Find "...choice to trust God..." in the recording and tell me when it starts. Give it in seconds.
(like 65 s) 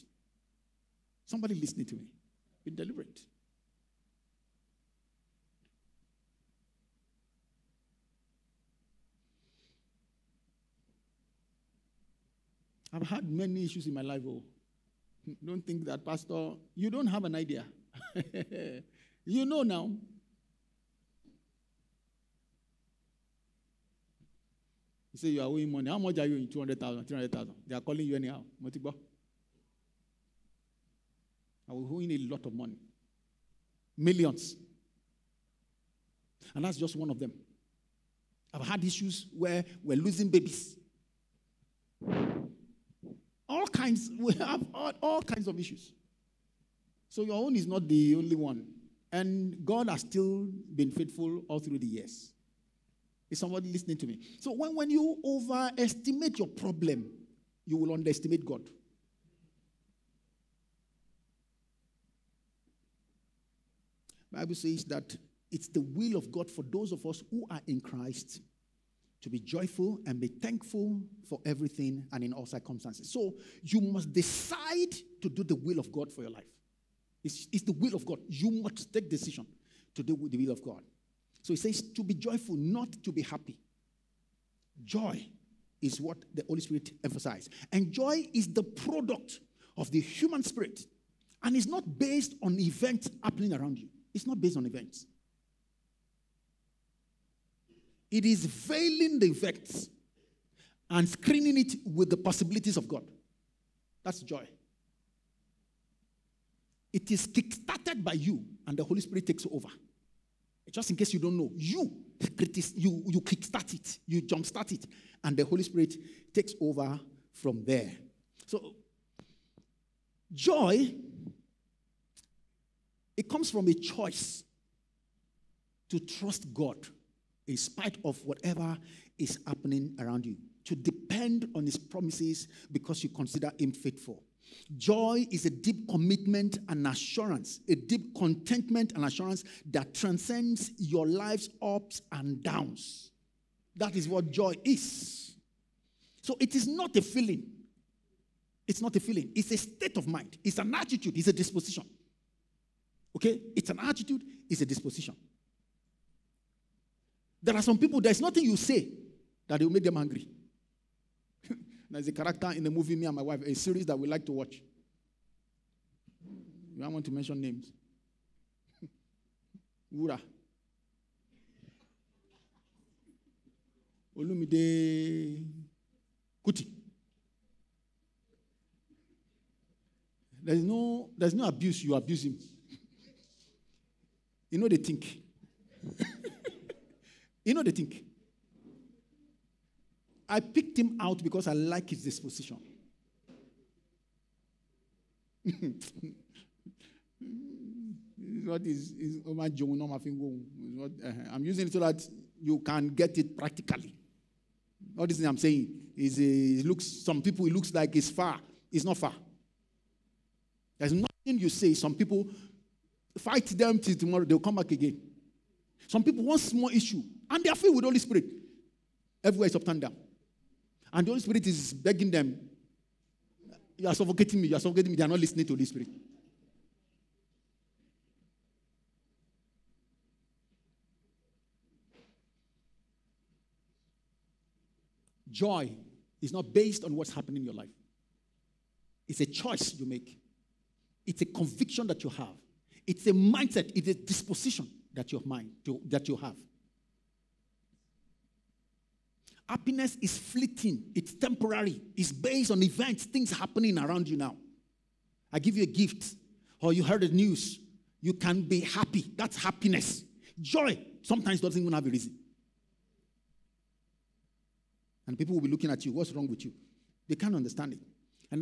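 123 s.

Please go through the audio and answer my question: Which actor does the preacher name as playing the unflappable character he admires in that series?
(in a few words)
Olumide Kuti.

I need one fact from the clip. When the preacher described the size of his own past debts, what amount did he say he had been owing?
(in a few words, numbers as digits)
Millions.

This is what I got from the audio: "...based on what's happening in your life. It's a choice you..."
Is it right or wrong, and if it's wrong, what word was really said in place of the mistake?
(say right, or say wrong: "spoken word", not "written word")
right.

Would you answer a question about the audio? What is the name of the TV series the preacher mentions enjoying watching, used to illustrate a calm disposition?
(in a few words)
Me and My Wife.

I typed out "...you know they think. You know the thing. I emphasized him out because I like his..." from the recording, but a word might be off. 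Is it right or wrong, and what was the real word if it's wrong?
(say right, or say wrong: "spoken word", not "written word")
wrong: "picked", not "emphasized".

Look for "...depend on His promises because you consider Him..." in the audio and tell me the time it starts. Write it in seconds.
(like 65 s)
130 s.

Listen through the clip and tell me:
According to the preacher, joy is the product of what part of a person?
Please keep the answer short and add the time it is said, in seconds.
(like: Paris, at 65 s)
the human spirit, at 89 s.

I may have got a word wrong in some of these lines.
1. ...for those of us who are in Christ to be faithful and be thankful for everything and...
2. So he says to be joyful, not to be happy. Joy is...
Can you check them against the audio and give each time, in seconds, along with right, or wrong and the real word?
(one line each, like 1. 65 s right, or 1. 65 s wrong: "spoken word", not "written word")
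1. 66 s wrong: "joyful", not "faithful"
2. 81 s right.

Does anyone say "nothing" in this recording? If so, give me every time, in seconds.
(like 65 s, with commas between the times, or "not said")
158 s, 210 s.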